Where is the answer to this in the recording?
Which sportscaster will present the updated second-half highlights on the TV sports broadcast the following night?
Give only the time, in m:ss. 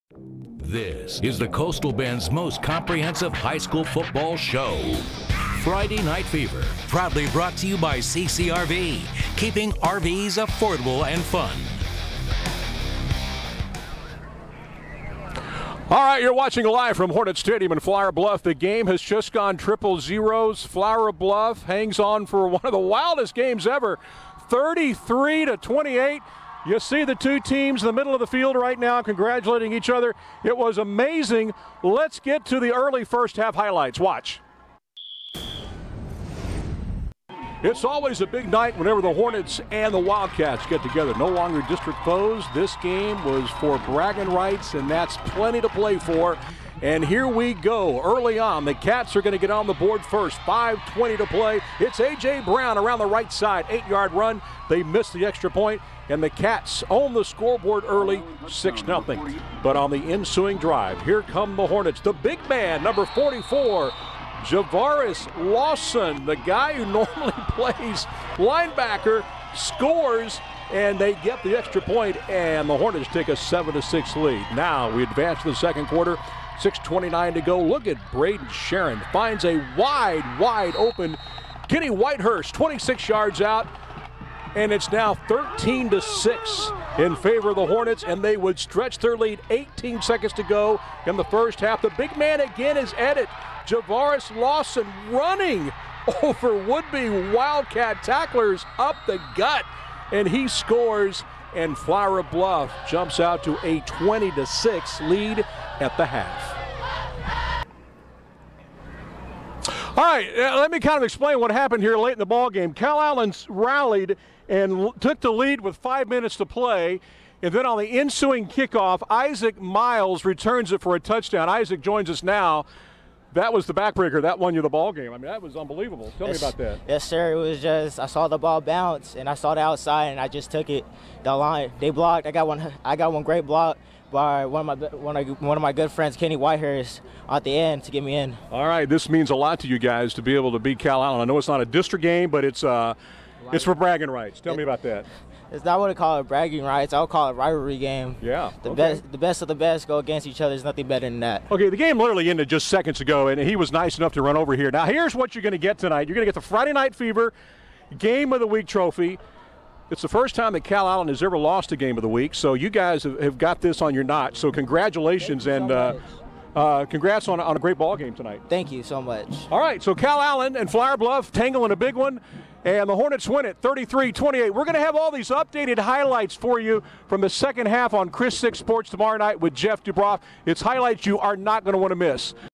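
2:59.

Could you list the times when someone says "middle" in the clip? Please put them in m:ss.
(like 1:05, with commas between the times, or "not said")
0:27.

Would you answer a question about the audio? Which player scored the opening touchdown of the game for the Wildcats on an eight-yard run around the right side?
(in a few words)
A.J. Brown.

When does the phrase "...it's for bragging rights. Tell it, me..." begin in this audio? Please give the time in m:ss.
2:23.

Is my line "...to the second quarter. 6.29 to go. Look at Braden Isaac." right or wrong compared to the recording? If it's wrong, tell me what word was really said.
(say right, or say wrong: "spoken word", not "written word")
wrong: "Sharon", not "Isaac".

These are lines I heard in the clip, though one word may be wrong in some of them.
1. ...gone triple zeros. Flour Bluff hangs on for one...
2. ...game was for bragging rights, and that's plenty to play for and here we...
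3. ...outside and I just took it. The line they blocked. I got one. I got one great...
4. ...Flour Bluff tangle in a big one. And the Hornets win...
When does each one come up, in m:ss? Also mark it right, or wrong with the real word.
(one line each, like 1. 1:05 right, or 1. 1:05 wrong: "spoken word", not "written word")
1. 0:19 right
2. 0:42 right
3. 2:09 right
4. 2:50 right.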